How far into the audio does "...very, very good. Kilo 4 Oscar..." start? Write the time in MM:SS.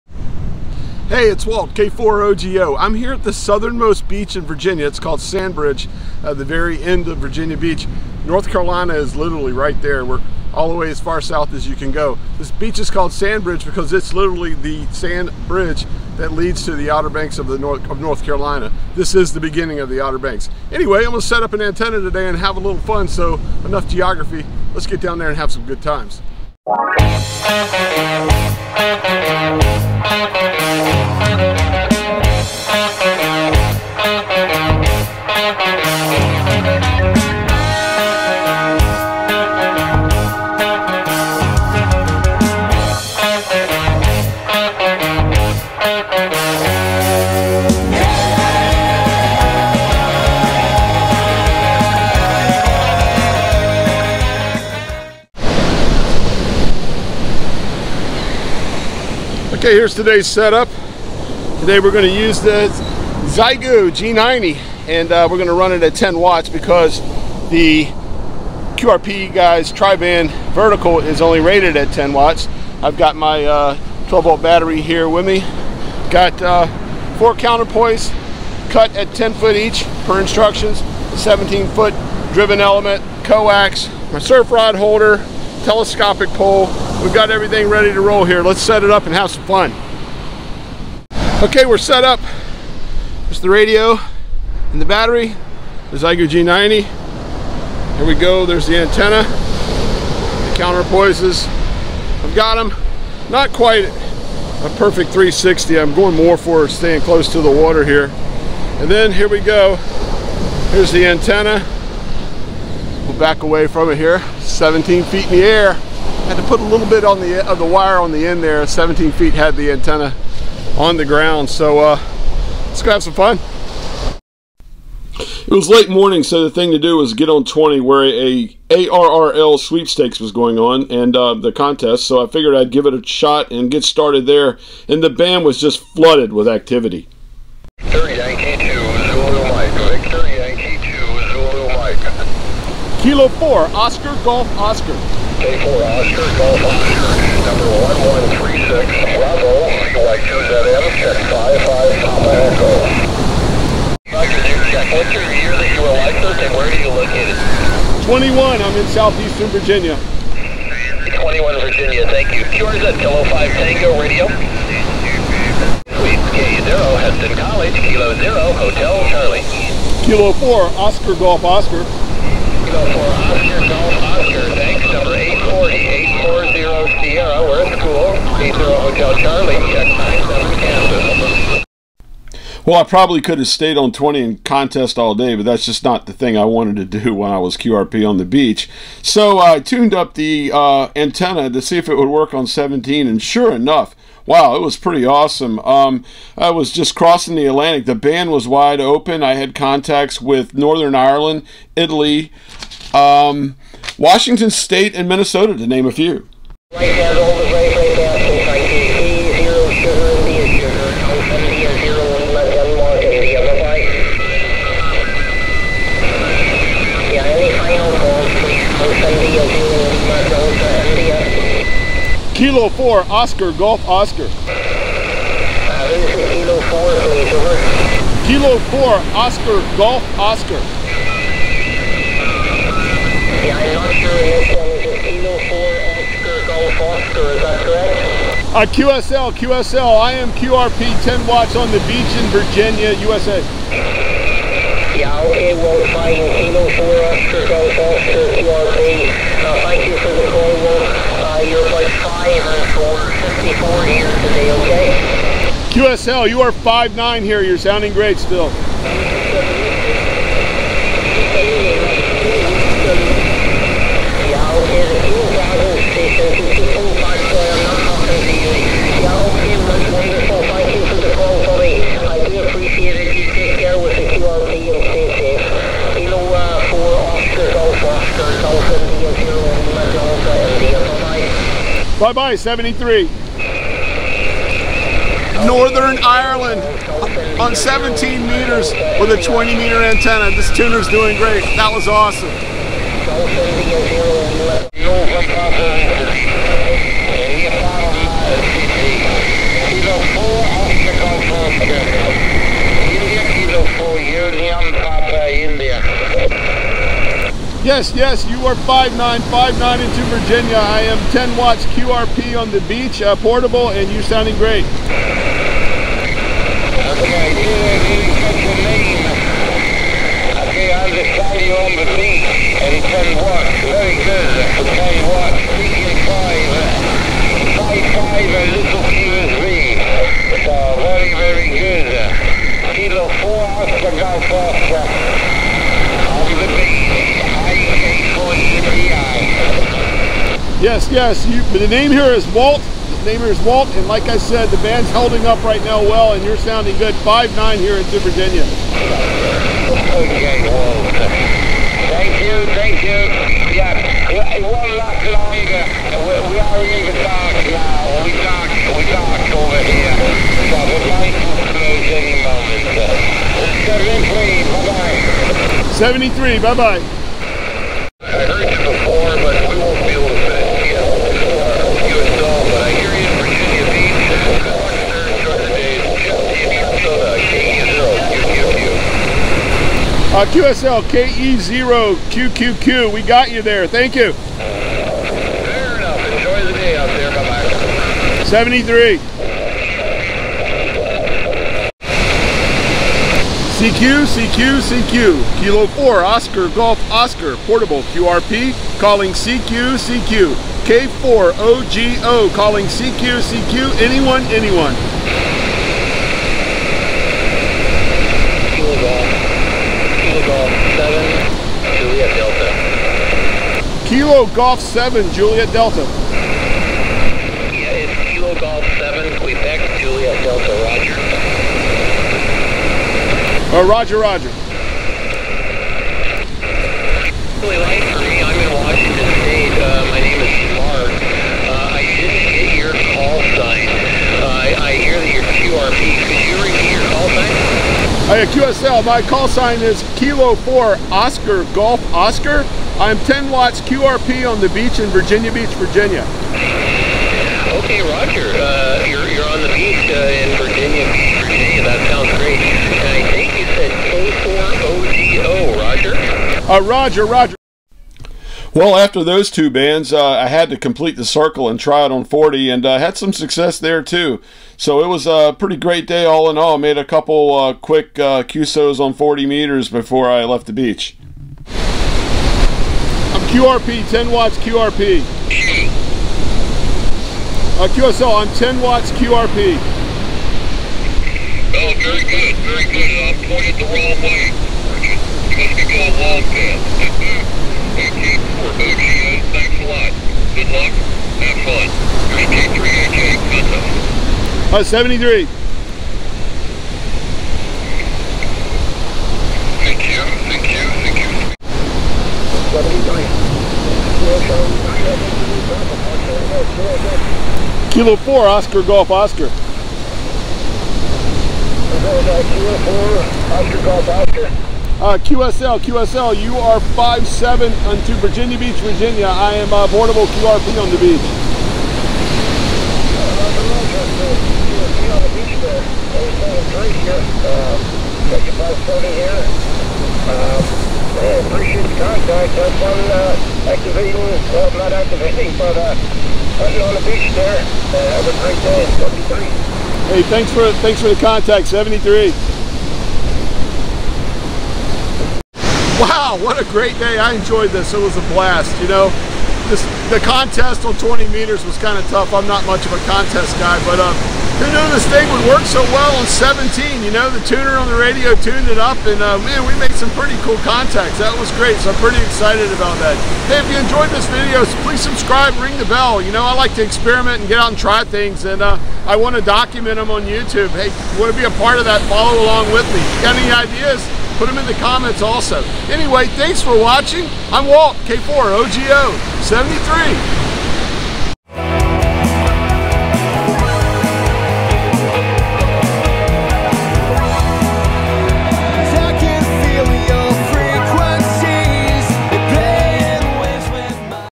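05:30.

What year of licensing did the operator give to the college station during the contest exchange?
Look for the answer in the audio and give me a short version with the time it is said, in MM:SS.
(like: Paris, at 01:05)
2021, at 02:38.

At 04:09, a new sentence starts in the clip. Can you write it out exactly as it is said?
Uh, thank you for the call, Wolf.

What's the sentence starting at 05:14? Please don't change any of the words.
Okay, dude, you catch your name.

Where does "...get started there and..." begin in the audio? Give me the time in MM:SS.
02:13.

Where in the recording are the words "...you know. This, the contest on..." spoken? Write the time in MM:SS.
09:08.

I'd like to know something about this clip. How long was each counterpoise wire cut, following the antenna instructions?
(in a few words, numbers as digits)
10 feet.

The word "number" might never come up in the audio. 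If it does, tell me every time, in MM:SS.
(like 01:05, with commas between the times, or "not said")
02:27, 02:54.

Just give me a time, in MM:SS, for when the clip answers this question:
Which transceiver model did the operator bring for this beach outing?
01:03.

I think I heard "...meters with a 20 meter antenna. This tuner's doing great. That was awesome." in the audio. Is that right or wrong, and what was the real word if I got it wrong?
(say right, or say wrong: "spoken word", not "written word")
right.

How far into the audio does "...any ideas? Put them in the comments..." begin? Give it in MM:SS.
09:33.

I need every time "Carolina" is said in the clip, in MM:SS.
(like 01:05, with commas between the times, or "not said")
00:08, 00:18.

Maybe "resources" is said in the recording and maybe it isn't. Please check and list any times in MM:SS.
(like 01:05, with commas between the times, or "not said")
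not said.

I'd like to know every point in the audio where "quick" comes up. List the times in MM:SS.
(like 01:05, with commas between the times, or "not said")
07:47.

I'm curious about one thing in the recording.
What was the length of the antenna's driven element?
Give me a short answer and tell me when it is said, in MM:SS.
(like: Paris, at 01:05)
17 feet, at 01:21.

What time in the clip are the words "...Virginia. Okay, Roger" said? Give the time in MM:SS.
07:25.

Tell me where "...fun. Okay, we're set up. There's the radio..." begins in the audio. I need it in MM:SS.
01:29.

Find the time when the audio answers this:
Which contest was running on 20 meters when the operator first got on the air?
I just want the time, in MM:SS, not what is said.
02:08.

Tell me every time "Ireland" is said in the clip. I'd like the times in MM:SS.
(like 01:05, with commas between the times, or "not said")
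03:20, 04:46.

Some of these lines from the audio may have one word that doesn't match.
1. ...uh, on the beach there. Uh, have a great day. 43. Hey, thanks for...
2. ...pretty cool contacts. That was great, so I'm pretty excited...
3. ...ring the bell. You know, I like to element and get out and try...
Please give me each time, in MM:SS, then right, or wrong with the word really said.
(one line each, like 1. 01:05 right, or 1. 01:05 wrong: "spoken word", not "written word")
1. 08:55 wrong: "73", not "43"
2. 09:19 right
3. 09:25 wrong: "experiment", not "element".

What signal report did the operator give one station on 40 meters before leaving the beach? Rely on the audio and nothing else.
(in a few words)
5-7.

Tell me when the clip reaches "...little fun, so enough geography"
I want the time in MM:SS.
00:22.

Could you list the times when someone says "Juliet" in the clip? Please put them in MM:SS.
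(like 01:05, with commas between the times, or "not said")
06:55, 06:59.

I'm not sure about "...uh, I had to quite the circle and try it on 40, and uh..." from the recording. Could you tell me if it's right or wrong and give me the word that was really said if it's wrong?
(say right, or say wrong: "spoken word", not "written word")
wrong: "complete", not "quite".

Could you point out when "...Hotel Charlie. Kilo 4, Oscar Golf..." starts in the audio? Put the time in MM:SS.
02:48.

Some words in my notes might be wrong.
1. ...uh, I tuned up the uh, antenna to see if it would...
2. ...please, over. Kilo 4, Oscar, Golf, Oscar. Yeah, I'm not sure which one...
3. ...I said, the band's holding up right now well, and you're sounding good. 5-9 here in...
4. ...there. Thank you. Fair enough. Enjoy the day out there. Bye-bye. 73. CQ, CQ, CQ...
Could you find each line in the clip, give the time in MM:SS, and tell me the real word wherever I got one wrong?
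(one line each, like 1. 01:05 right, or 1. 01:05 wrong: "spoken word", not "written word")
1. 03:09 right
2. 03:47 right
3. 05:44 right
4. 06:23 right.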